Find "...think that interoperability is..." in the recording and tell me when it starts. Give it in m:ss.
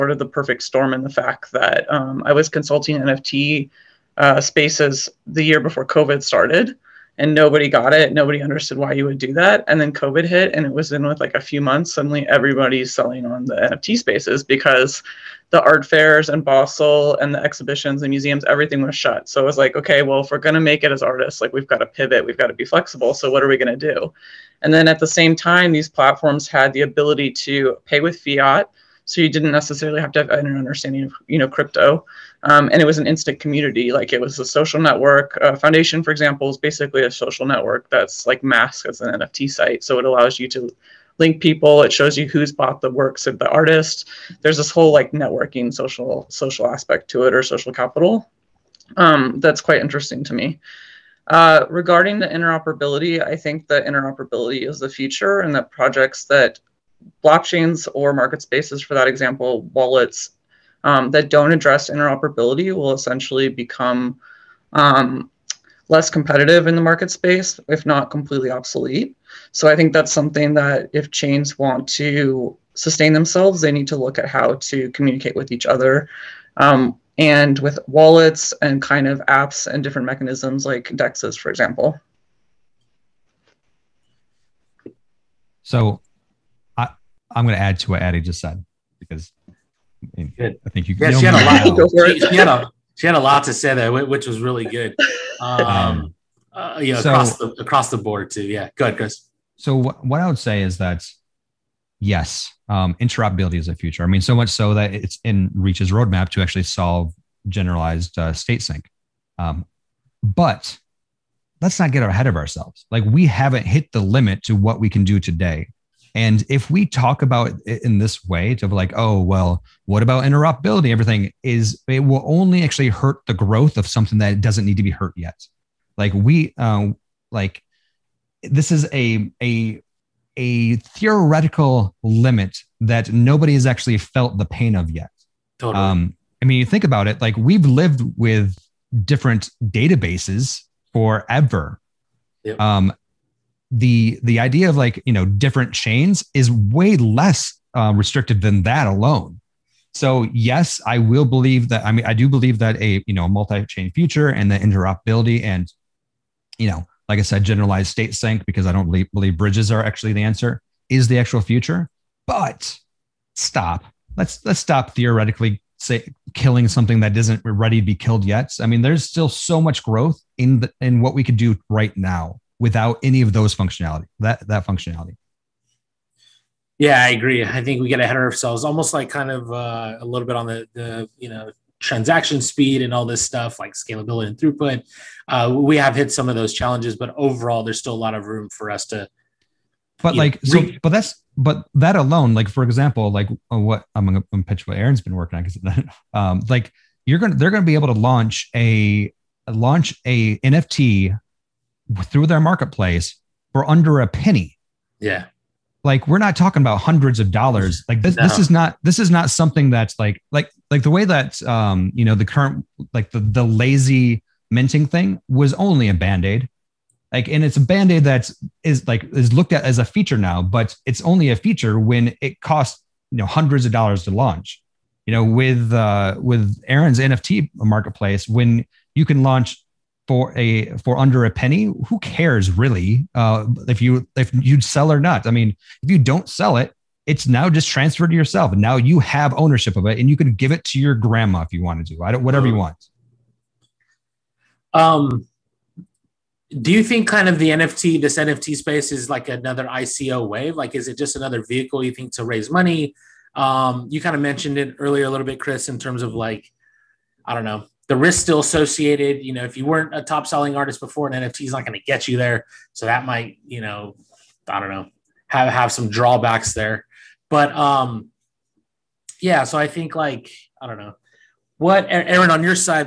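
0:53.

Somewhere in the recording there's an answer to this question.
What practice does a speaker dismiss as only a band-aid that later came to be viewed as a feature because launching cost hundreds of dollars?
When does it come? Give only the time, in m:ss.
3:33.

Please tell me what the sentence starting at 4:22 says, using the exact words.
So that might, you know, I don't know, have have some drawbacks there.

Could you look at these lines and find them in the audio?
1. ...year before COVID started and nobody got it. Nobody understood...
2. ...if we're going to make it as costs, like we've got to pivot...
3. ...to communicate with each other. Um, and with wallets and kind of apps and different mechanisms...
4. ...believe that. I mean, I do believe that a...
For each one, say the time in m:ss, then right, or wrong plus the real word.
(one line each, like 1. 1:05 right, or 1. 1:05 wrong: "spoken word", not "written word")
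1. 0:05 right
2. 0:20 wrong: "artists", not "costs"
3. 1:14 right
4. 2:31 right.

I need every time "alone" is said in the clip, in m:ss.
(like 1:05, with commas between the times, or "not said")
2:28, 3:11.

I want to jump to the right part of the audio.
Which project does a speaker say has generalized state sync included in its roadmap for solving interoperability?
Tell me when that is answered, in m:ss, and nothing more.
1:45.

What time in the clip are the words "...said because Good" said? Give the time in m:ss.
1:28.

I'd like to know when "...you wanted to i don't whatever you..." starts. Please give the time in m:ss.
4:01.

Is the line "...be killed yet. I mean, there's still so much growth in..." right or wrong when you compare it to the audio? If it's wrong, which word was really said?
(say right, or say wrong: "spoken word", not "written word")
right.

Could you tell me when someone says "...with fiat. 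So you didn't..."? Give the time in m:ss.
0:28.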